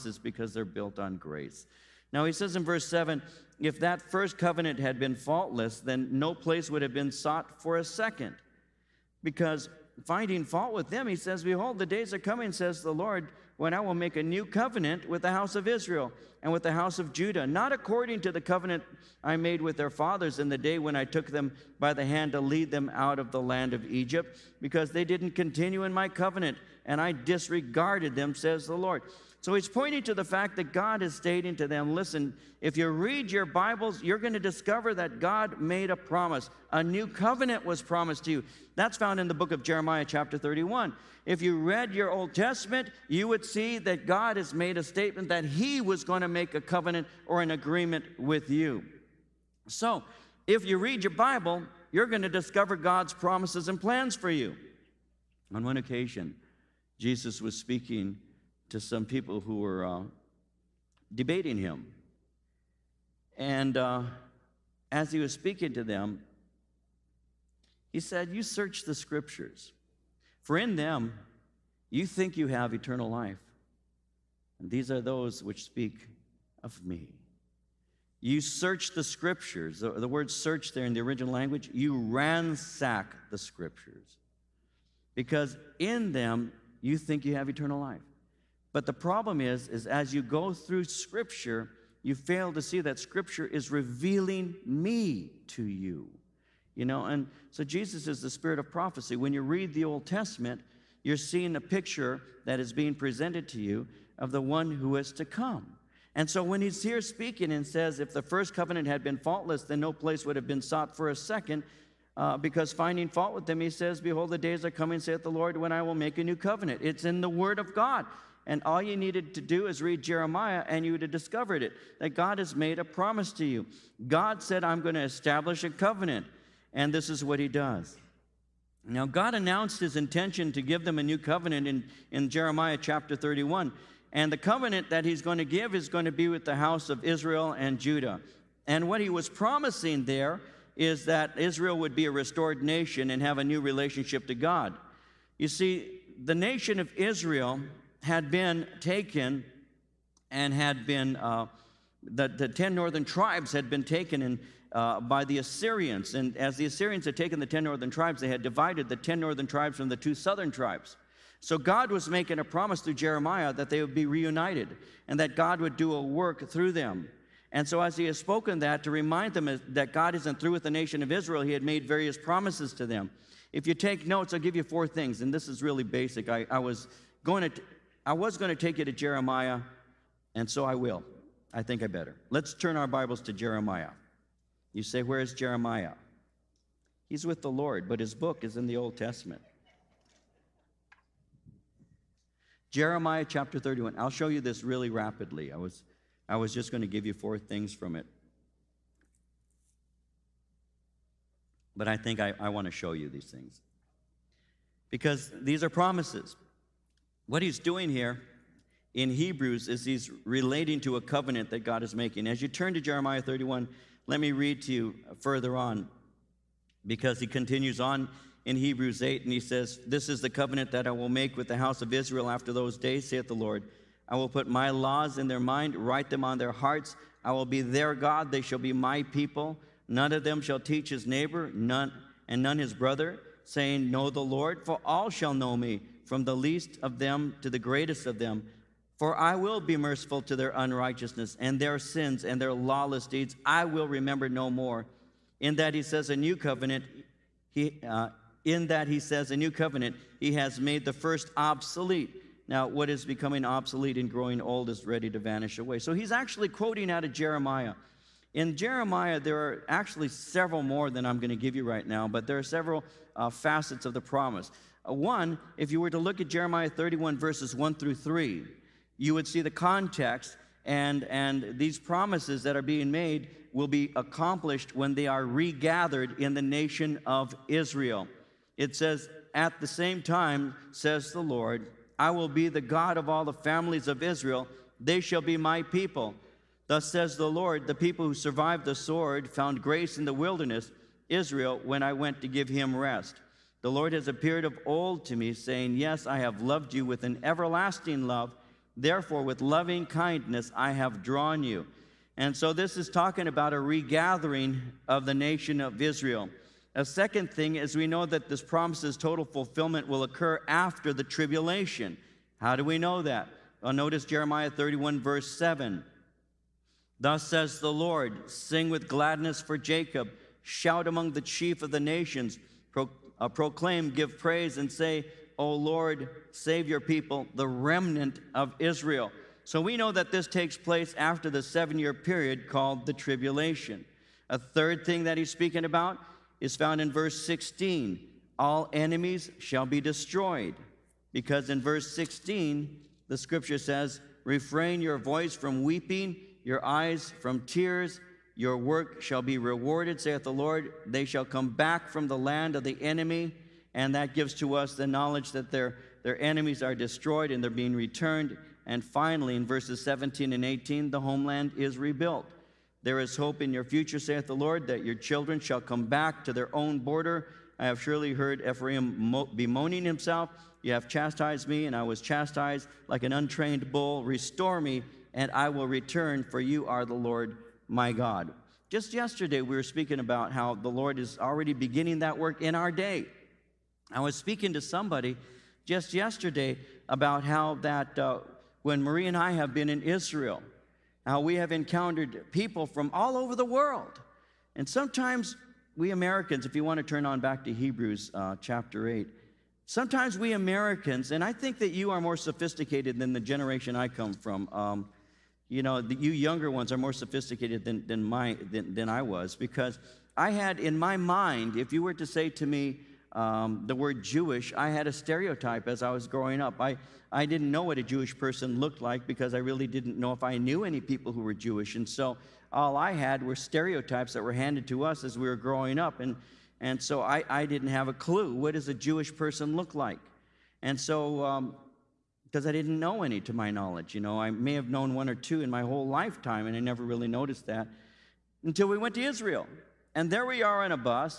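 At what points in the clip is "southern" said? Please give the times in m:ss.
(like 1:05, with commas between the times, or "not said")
2:40.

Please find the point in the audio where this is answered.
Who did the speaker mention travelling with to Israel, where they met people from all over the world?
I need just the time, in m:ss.
6:28.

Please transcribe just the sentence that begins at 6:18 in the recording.
Just yesterday, we were speaking about how the Lord is already beginning that work in our day.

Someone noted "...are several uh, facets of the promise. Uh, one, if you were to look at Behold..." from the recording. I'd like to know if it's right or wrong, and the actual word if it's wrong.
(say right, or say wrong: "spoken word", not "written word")
wrong: "Jeremiah", not "Behold".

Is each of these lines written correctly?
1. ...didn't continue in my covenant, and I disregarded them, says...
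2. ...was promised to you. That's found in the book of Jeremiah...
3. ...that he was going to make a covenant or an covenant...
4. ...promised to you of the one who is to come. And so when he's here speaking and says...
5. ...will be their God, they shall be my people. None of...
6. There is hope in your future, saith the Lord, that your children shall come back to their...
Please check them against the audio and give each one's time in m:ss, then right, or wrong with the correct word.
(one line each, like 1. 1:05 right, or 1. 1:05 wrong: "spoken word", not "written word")
1. 0:25 right
2. 0:37 right
3. 0:45 wrong: "agreement", not "covenant"
4. 1:42 wrong: "presented", not "promised"
5. 3:47 right
6. 6:02 right.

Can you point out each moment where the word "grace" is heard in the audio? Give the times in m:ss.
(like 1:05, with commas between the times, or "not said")
0:01, 4:49.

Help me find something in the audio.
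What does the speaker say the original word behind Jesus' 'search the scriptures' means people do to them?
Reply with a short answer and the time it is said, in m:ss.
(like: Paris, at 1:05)
ransack, at 1:21.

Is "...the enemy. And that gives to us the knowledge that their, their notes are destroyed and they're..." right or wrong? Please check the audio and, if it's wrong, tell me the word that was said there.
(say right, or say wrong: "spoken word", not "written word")
wrong: "enemies", not "notes".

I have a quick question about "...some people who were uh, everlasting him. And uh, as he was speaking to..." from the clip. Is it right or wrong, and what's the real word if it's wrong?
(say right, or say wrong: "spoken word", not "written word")
wrong: "debating", not "everlasting".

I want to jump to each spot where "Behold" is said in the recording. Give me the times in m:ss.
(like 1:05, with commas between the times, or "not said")
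0:11, 1:54.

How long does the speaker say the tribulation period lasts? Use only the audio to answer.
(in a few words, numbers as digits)
7 years.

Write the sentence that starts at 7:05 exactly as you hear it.
And, and so I, I didn't have a clue what does a Jewish person look like?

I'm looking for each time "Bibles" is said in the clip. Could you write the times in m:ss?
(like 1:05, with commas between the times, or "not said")
0:33, 0:51, 3:02.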